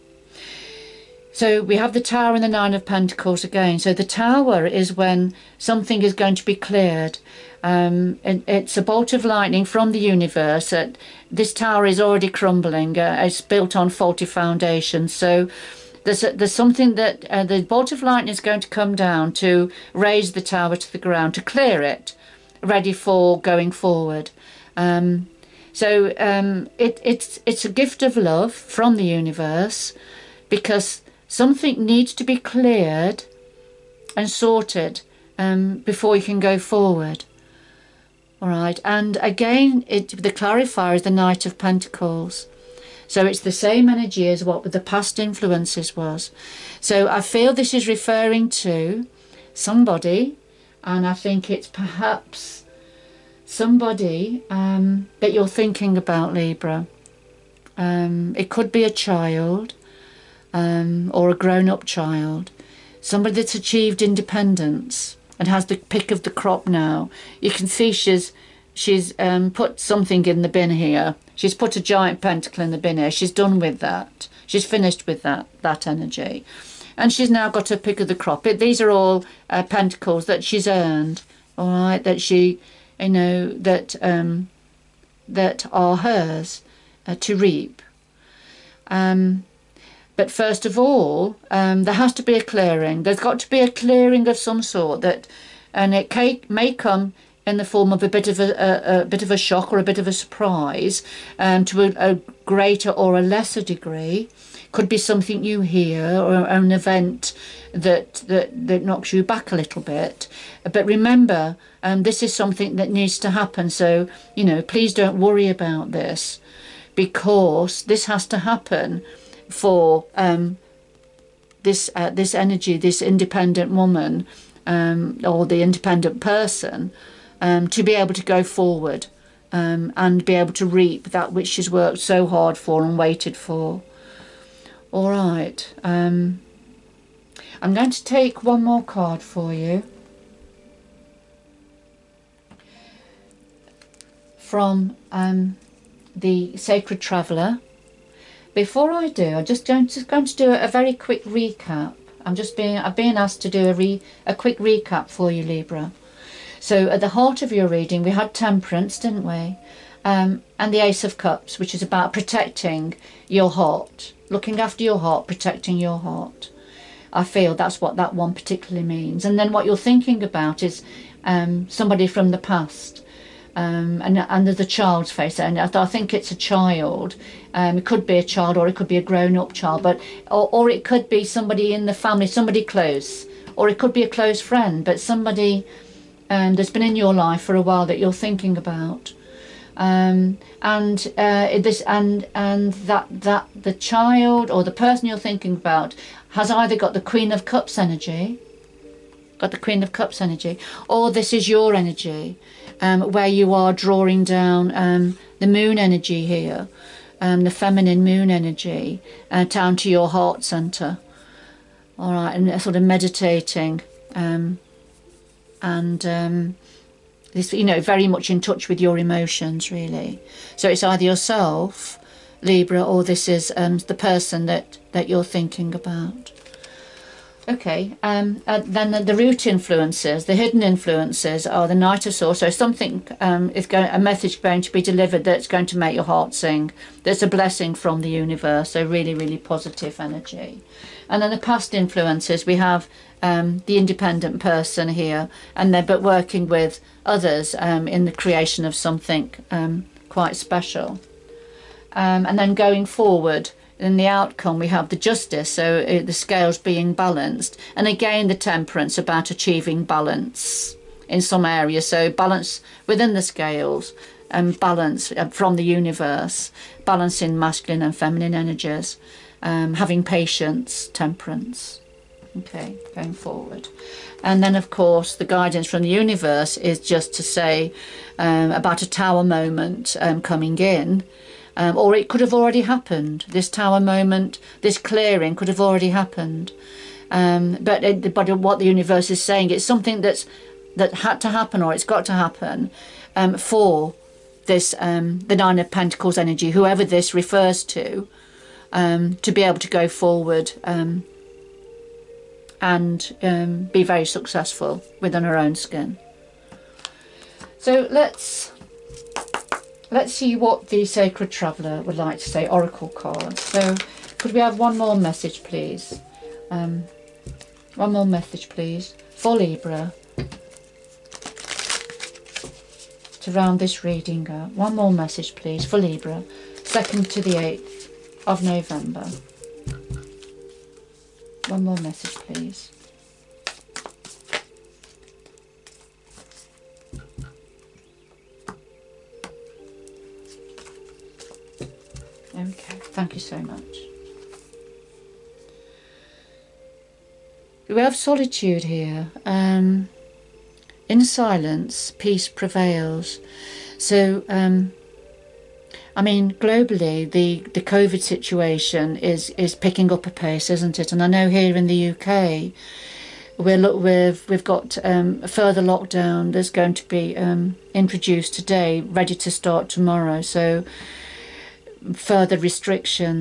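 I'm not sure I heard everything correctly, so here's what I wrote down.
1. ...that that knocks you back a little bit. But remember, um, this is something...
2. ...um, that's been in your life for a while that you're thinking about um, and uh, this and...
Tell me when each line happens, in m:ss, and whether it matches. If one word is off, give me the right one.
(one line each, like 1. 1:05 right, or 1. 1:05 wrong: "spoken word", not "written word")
1. 1:48 right
2. 3:06 right.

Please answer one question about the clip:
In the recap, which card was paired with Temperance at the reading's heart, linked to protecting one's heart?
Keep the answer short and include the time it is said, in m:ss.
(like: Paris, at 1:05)
Ace of Cups, at 2:40.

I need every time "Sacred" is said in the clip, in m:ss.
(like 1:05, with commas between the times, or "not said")
2:26, 5:10.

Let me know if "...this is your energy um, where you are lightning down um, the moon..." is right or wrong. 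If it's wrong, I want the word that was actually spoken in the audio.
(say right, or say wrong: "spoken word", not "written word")
wrong: "drawing", not "lightning".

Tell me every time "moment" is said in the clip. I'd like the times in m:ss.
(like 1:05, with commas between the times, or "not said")
4:39, 4:43.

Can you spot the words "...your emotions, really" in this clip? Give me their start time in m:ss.
3:38.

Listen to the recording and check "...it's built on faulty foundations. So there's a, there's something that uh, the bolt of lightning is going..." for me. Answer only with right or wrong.
right.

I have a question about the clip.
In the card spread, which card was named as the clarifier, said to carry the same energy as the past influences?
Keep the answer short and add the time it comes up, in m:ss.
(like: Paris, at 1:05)
Knight of Pentacles, at 0:41.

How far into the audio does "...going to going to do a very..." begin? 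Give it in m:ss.
2:29.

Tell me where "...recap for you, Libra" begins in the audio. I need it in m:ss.
2:34.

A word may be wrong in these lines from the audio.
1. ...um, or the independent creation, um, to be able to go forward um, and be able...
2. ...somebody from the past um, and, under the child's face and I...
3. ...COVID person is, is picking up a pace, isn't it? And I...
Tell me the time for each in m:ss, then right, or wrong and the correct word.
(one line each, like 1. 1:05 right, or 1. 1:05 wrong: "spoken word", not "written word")
1. 2:04 wrong: "person", not "creation"
2. 2:51 right
3. 5:57 wrong: "situation", not "person".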